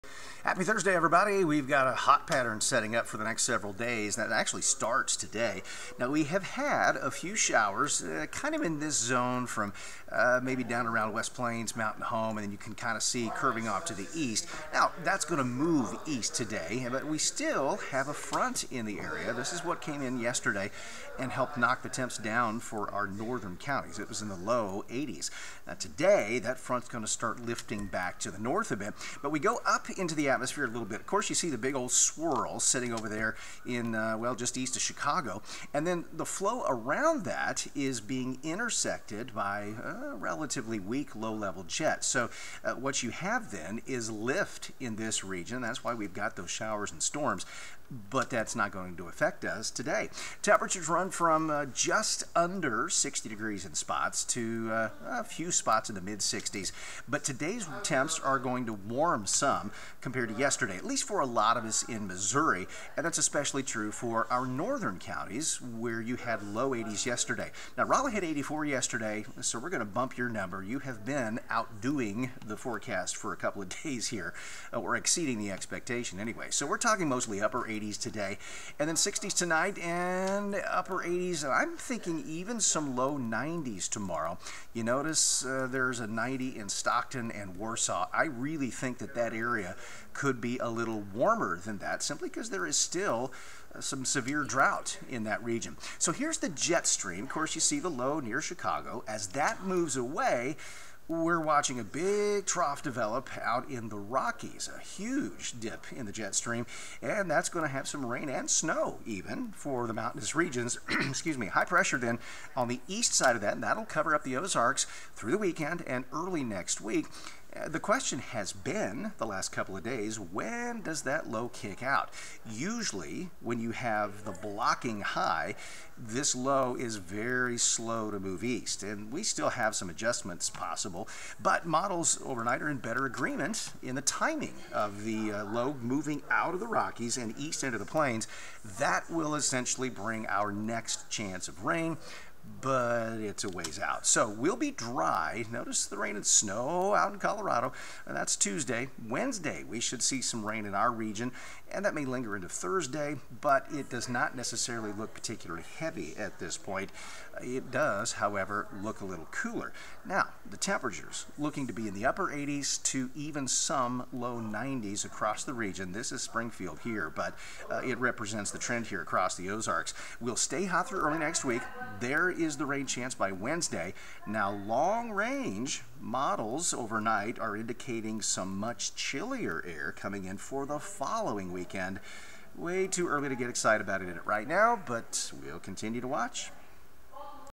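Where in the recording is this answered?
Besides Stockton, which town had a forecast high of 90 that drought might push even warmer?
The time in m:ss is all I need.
1:27.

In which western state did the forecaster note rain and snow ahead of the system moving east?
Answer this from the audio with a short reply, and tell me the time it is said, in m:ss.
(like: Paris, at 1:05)
Colorado, at 2:27.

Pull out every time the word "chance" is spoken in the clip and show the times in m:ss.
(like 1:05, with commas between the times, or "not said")
2:21, 2:52.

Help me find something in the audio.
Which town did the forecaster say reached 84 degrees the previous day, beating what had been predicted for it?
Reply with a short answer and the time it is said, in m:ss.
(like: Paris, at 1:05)
Rolla, at 1:07.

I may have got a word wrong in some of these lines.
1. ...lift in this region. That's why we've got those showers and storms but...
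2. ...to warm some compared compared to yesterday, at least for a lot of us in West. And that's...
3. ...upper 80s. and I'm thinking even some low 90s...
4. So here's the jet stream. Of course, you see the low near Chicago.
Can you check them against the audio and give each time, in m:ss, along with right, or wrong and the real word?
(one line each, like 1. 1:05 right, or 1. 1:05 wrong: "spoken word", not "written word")
1. 0:44 right
2. 0:58 wrong: "Missouri", not "West"
3. 1:20 right
4. 1:35 right.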